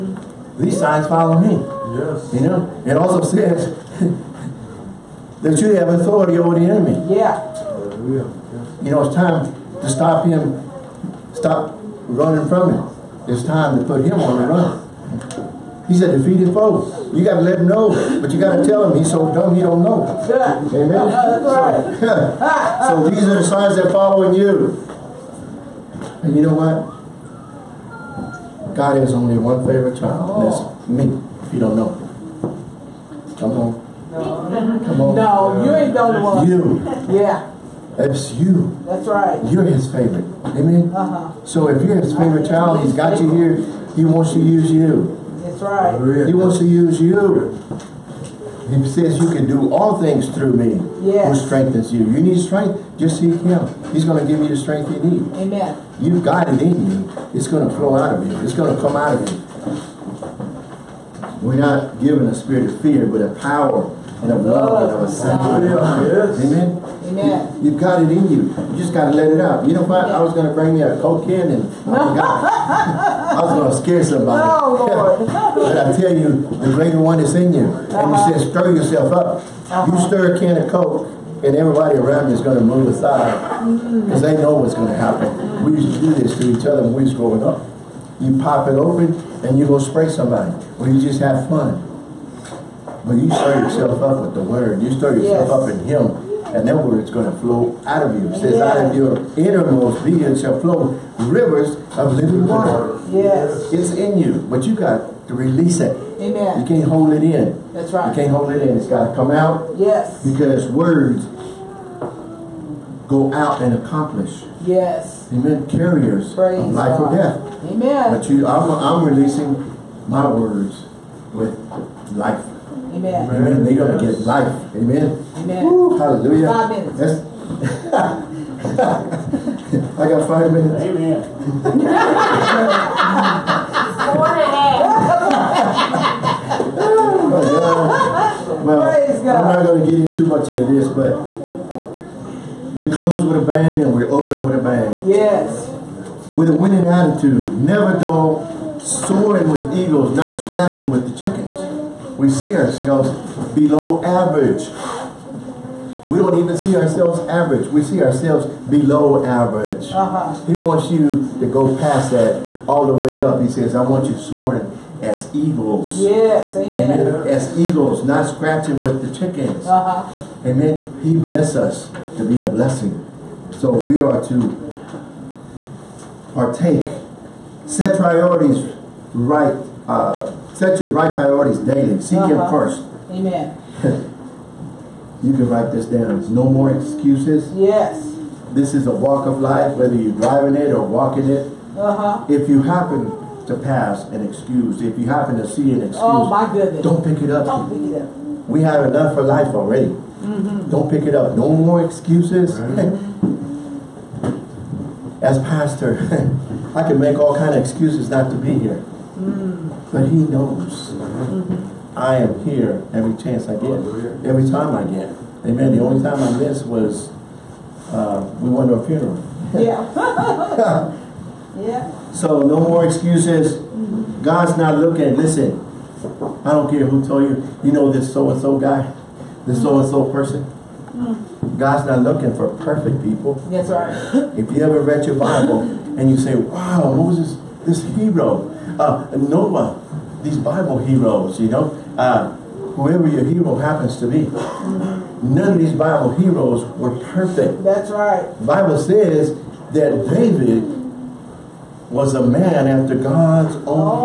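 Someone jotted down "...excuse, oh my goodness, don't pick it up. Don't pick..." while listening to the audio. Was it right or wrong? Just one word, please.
right.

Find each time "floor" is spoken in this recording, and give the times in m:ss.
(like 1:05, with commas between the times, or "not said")
not said.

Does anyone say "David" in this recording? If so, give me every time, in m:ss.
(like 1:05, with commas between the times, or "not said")
4:10.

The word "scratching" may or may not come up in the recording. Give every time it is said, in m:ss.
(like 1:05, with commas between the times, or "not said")
2:30, 2:48.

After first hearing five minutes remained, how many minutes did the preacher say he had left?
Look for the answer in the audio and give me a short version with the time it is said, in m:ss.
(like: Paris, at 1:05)
4 and a half, at 2:14.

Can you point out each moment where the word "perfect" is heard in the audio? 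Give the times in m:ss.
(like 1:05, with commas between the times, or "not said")
3:52, 4:07.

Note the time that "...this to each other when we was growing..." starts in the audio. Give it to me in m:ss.
1:26.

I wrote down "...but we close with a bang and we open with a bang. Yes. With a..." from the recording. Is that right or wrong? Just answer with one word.
right.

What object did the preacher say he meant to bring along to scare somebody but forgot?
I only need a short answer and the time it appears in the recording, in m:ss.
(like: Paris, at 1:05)
Coke can, at 1:11.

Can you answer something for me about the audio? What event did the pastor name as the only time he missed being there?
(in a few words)
A funeral.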